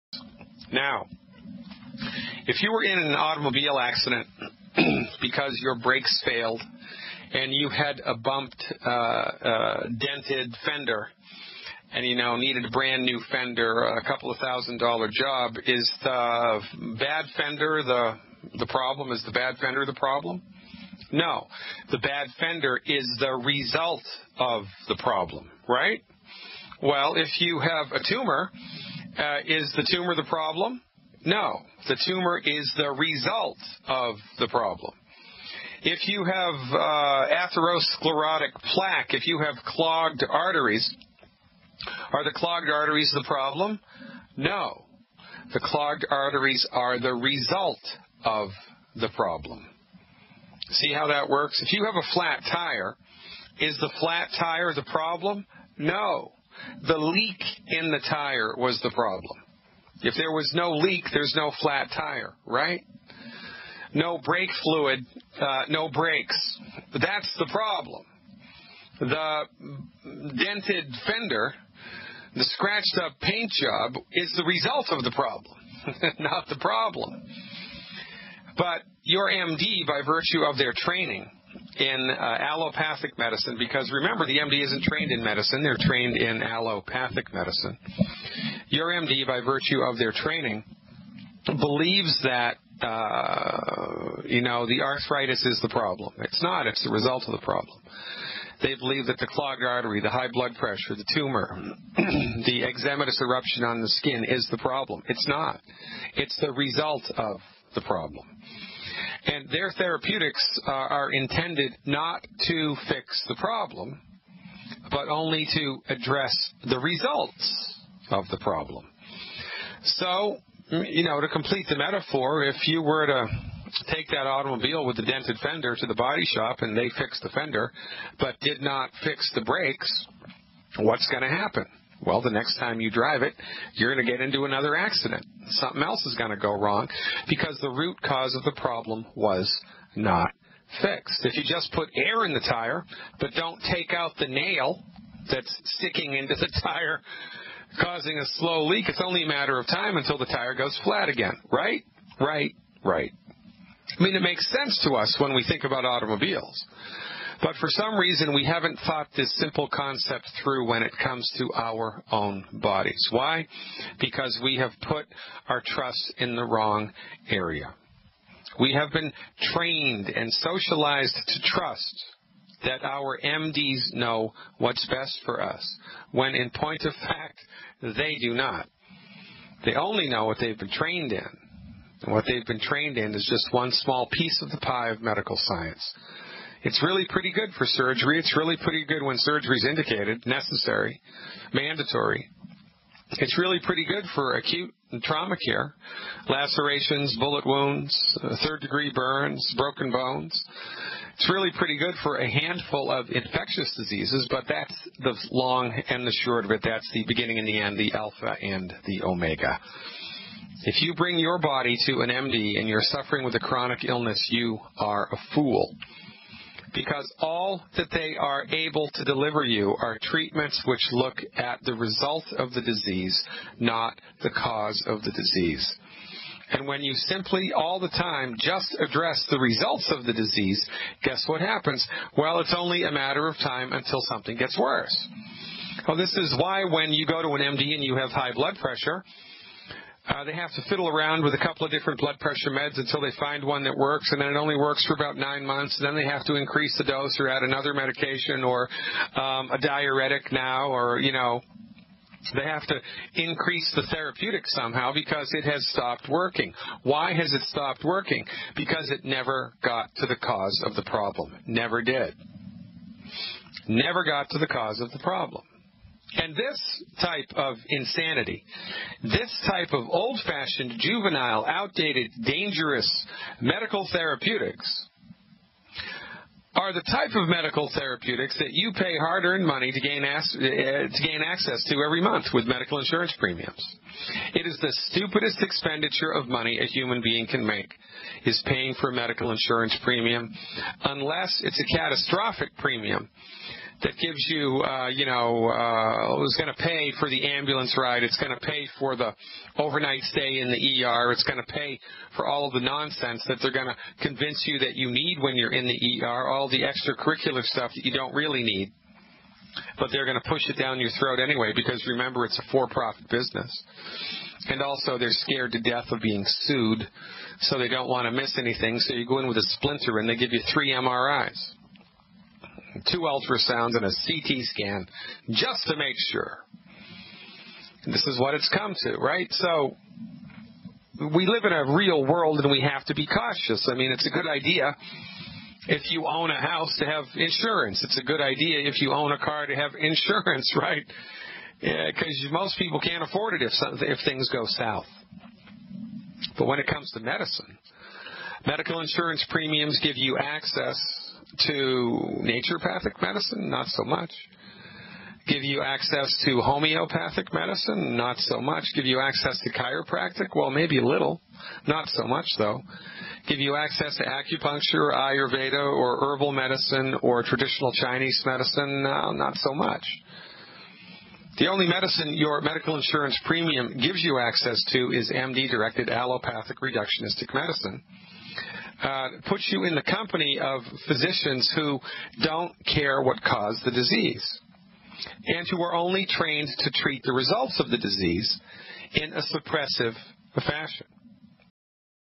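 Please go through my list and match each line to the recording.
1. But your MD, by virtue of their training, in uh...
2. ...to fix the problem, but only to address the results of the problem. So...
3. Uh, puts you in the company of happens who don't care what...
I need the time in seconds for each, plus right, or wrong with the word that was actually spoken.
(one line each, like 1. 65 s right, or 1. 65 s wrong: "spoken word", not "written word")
1. 78 s right
2. 112 s right
3. 378 s wrong: "physicians", not "happens".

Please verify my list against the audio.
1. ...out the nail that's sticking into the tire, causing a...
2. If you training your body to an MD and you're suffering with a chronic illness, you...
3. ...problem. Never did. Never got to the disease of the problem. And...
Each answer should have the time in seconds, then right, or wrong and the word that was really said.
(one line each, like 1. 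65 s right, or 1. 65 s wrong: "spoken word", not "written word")
1. 143 s right
2. 210 s wrong: "bring", not "training"
3. 260 s wrong: "cause", not "disease".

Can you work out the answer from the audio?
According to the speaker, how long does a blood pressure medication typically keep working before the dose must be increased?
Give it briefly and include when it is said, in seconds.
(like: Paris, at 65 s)
about 9 months, at 245 s.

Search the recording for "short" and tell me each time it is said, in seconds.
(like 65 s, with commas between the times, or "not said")
206 s.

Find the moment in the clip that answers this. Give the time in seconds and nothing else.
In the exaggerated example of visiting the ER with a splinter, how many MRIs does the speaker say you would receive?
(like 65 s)
320 s.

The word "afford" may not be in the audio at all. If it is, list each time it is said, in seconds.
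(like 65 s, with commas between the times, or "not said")
343 s.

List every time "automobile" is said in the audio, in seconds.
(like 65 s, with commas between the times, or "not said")
3 s, 124 s, 155 s.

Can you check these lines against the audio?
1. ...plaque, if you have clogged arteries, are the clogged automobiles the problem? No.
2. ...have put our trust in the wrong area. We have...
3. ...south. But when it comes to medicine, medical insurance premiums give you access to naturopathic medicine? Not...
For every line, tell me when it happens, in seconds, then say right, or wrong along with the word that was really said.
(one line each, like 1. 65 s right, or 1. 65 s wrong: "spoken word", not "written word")
1. 38 s wrong: "arteries", not "automobiles"
2. 164 s right
3. 344 s right.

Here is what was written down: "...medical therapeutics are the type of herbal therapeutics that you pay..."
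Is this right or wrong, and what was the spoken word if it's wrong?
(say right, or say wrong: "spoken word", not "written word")
wrong: "medical", not "herbal".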